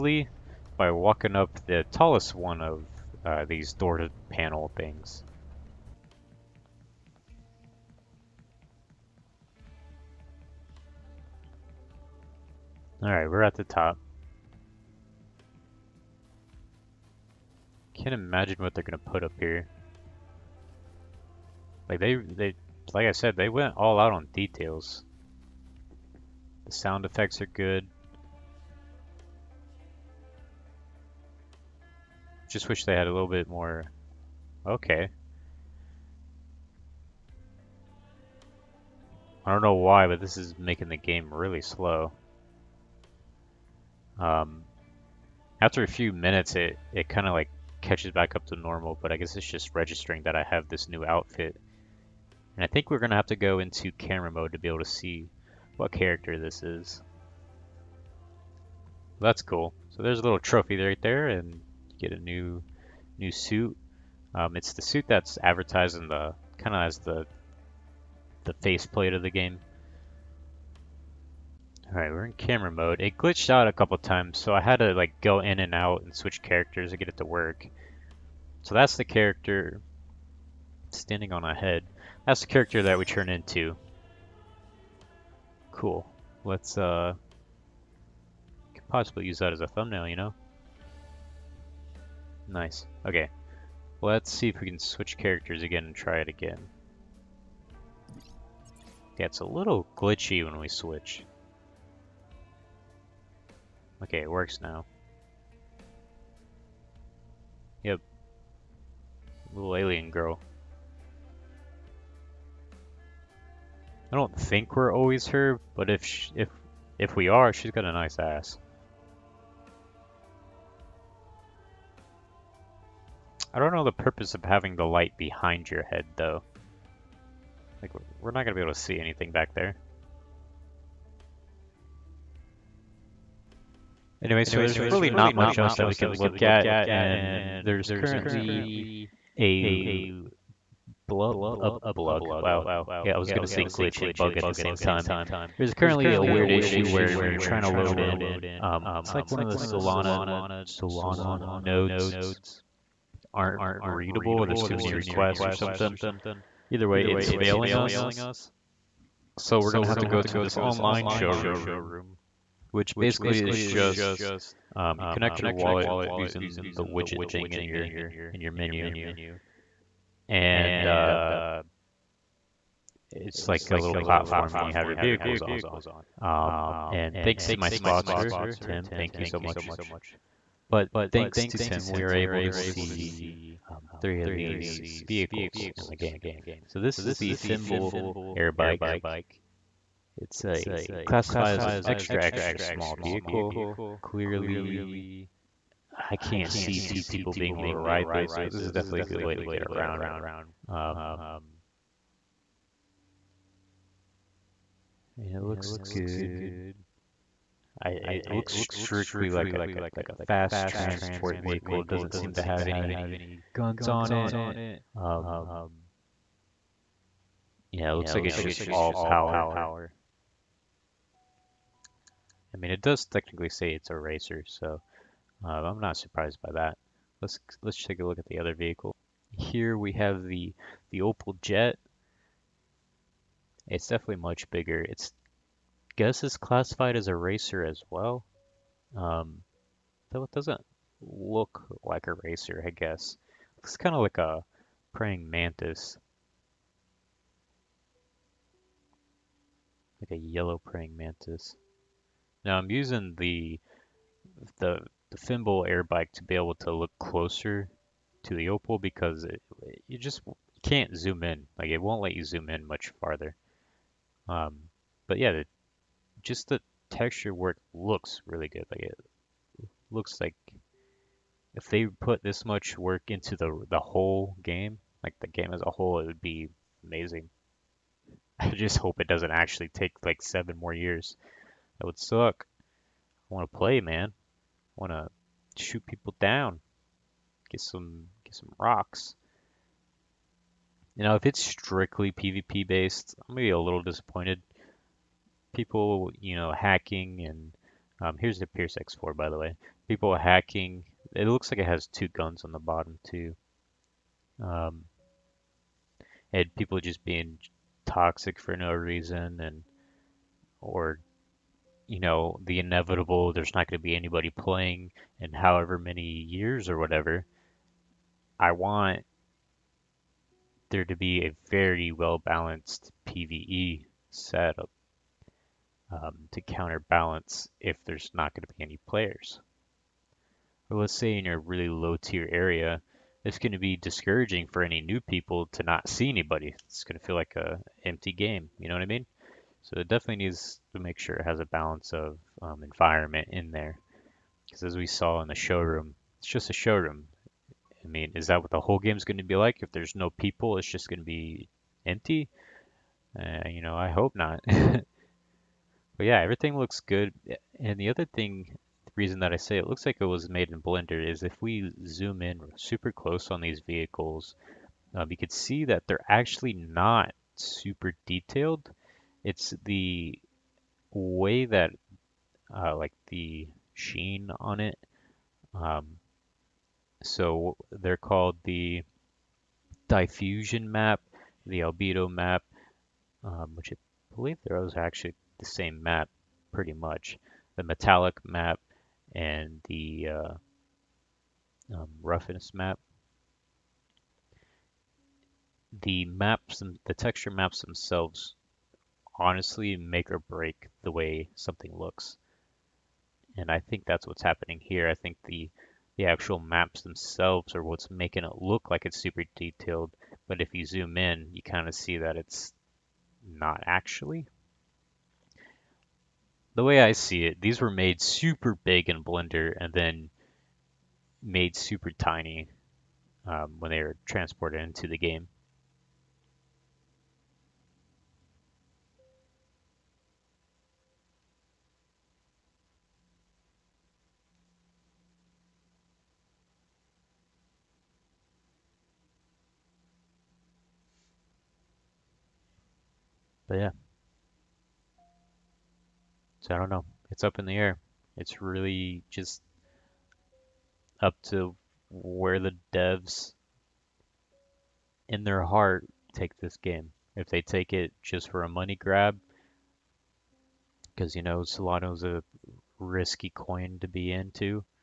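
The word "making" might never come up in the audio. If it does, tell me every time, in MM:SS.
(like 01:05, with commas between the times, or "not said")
00:40, 06:47.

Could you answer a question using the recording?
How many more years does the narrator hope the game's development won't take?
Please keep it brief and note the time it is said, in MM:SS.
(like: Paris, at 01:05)
7, at 04:40.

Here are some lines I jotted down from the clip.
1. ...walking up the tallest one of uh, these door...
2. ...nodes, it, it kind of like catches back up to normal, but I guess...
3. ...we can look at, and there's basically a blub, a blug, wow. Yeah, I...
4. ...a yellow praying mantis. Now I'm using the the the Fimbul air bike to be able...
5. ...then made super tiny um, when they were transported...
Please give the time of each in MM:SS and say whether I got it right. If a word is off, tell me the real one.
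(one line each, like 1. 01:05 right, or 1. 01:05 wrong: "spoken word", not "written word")
1. 00:00 right
2. 00:46 wrong: "minutes", not "nodes"
3. 02:15 wrong: "currently", not "basically"
4. 04:10 right
5. 06:59 right.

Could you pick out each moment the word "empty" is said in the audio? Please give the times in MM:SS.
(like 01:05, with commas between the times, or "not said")
05:37, 05:51.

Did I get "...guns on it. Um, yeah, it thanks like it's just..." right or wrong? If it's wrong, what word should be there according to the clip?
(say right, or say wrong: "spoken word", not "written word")
wrong: "looks", not "thanks".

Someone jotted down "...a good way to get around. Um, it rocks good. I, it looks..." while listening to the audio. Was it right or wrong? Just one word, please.
wrong.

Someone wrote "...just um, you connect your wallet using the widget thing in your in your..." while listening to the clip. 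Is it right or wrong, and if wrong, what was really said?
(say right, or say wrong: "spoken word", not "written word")
right.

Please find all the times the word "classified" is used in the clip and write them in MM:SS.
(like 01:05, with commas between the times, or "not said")
03:11, 03:56.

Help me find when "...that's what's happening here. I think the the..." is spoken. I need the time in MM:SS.
06:43.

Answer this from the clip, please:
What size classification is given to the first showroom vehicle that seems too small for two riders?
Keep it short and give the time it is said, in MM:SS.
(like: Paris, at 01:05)
extra extra small, at 03:11.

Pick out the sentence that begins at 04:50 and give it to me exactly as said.
You know, if it's strictly PvP based, I'm gonna be a little disappointed.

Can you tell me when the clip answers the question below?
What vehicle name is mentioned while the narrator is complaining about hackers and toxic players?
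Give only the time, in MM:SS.
04:58.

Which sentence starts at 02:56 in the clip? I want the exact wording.
Um, and thanks to my sponsor, Tim, thank you so much.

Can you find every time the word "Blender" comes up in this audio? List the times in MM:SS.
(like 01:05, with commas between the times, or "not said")
06:00, 06:59.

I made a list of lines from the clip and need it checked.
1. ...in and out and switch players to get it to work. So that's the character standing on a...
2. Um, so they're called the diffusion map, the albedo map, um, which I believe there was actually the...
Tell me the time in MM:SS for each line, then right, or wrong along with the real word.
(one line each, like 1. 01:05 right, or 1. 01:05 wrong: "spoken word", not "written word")
1. 01:15 wrong: "characters", not "players"
2. 06:15 right.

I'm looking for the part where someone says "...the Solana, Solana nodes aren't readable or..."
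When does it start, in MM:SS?
02:29.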